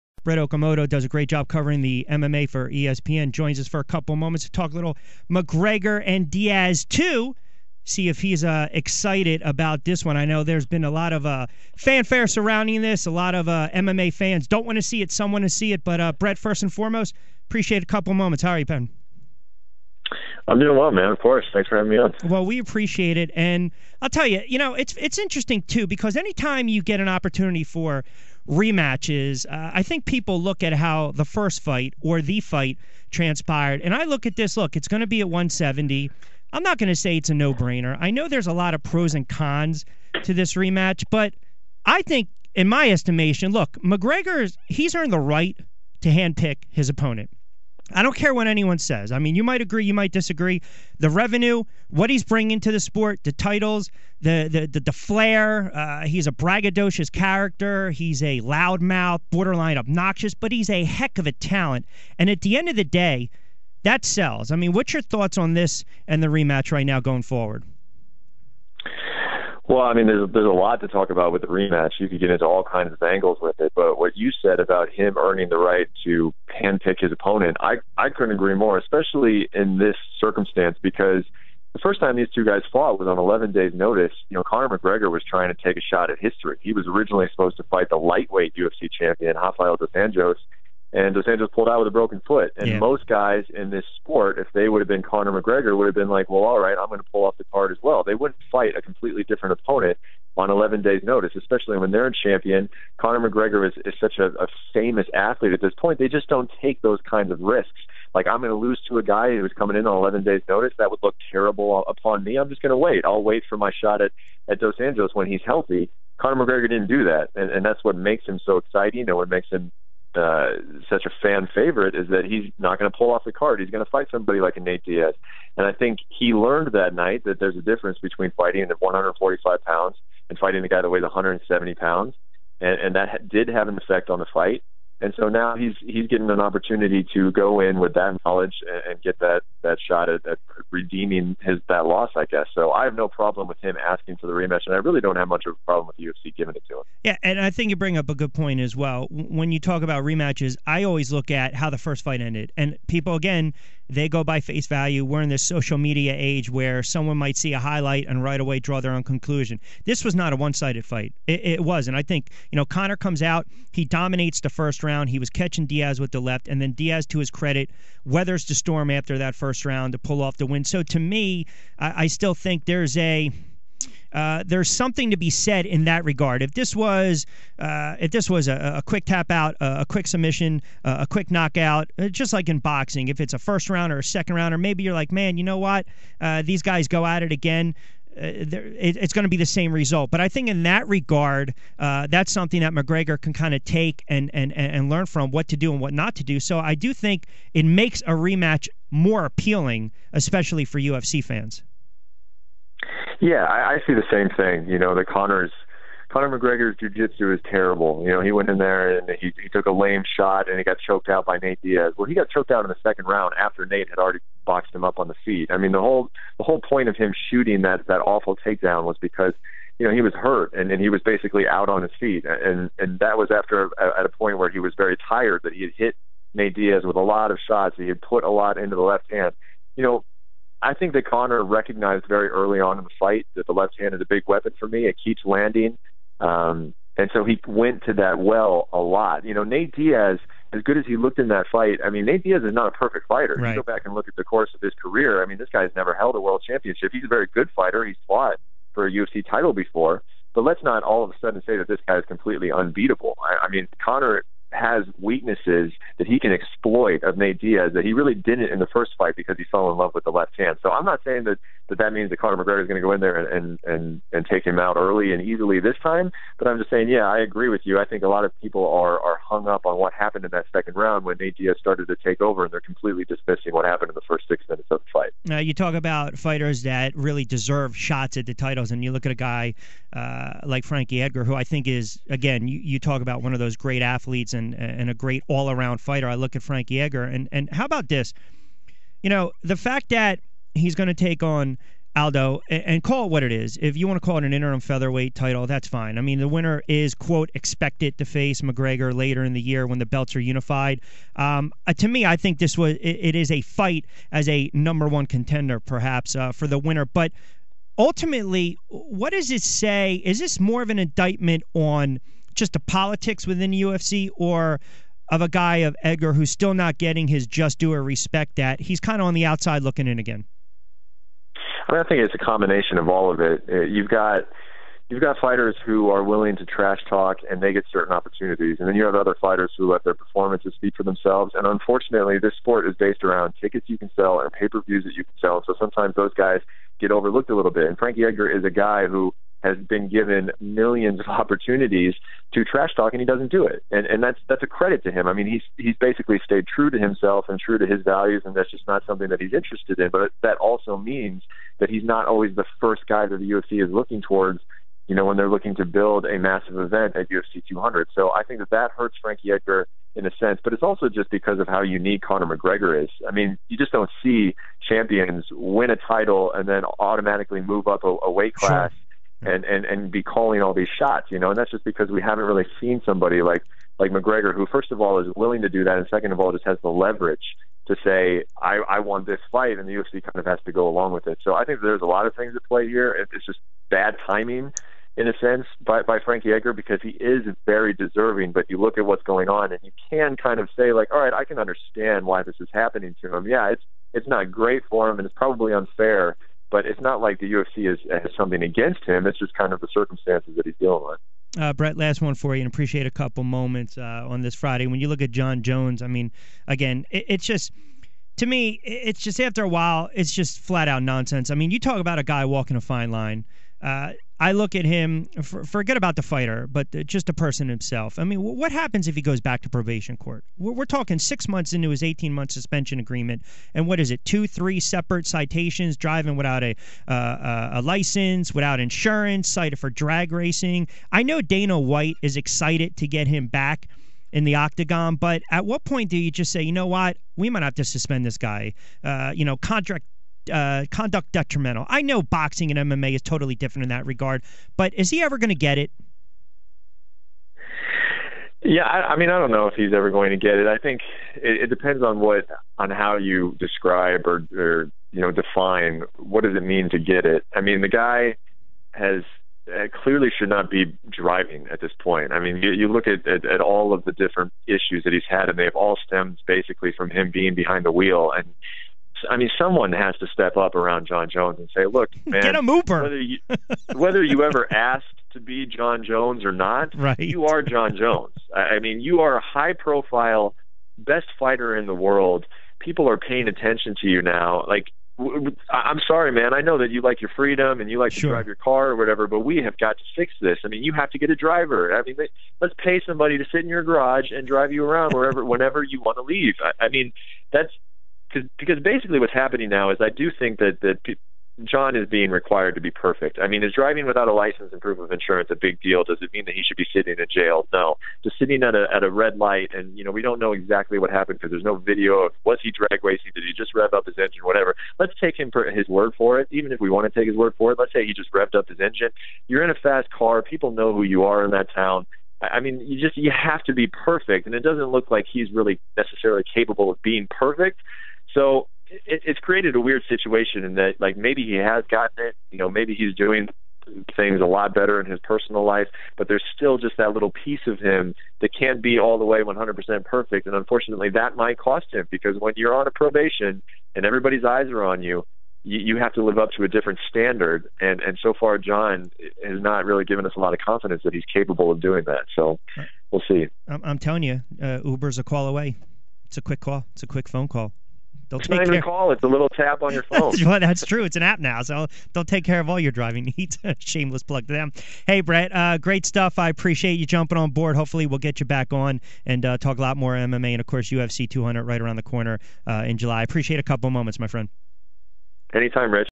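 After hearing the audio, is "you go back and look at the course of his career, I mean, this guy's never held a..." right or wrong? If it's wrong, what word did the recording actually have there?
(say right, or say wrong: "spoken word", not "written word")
right.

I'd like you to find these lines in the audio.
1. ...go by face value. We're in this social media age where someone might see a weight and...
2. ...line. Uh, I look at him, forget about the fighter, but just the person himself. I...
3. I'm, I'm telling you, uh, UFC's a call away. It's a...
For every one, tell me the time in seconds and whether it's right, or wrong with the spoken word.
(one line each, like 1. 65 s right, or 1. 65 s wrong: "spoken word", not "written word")
1. 154 s wrong: "highlight", not "weight"
2. 412 s right
3. 553 s wrong: "Uber", not "UFC".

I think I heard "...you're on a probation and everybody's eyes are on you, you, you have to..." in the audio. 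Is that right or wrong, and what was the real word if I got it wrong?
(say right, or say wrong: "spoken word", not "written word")
right.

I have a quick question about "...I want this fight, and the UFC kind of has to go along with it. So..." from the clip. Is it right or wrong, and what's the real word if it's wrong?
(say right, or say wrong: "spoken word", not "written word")
right.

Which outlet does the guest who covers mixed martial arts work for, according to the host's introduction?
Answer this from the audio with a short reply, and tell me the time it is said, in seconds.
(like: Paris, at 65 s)
ESPN, at 2 s.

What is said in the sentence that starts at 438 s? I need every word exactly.
Uh, you know, contract uh, conduct detrimental.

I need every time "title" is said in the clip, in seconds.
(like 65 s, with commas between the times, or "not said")
53 s, 249 s, 278 s, 295 s, 365 s.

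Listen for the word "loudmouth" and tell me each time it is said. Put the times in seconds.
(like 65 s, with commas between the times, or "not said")
58 s.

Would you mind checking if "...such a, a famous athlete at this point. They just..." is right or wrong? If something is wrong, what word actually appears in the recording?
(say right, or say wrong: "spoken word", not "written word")
right.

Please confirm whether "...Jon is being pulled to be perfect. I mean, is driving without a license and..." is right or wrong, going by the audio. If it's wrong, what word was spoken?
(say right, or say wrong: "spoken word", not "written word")
wrong: "required", not "pulled".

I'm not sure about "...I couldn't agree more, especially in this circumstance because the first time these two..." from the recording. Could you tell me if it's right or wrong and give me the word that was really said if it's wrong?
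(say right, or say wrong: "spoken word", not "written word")
right.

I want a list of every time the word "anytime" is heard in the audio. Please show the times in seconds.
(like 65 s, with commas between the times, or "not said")
26 s, 575 s.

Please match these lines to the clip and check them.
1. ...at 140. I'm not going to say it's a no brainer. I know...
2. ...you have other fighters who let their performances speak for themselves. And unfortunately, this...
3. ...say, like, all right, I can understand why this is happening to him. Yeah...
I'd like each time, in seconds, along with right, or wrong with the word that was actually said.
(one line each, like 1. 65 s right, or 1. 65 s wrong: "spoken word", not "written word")
1. 35 s wrong: "170", not "140"
2. 328 s right
3. 390 s right.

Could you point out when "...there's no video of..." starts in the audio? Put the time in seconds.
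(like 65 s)
511 s.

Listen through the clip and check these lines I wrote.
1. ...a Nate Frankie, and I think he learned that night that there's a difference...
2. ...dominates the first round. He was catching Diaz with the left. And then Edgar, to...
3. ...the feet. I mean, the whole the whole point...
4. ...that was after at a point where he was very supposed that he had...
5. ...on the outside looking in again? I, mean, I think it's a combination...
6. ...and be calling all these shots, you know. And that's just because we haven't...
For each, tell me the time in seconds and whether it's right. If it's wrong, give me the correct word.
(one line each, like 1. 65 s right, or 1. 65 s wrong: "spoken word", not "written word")
1. 124 s wrong: "Diaz", not "Frankie"
2. 163 s wrong: "Diaz", not "Edgar"
3. 215 s right
4. 222 s wrong: "tired", not "supposed"
5. 319 s right
6. 369 s right.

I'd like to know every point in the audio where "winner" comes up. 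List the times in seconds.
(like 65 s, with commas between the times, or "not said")
296 s, 306 s.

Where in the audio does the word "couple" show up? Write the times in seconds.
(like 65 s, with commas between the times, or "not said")
3 s, 17 s, 402 s, 573 s.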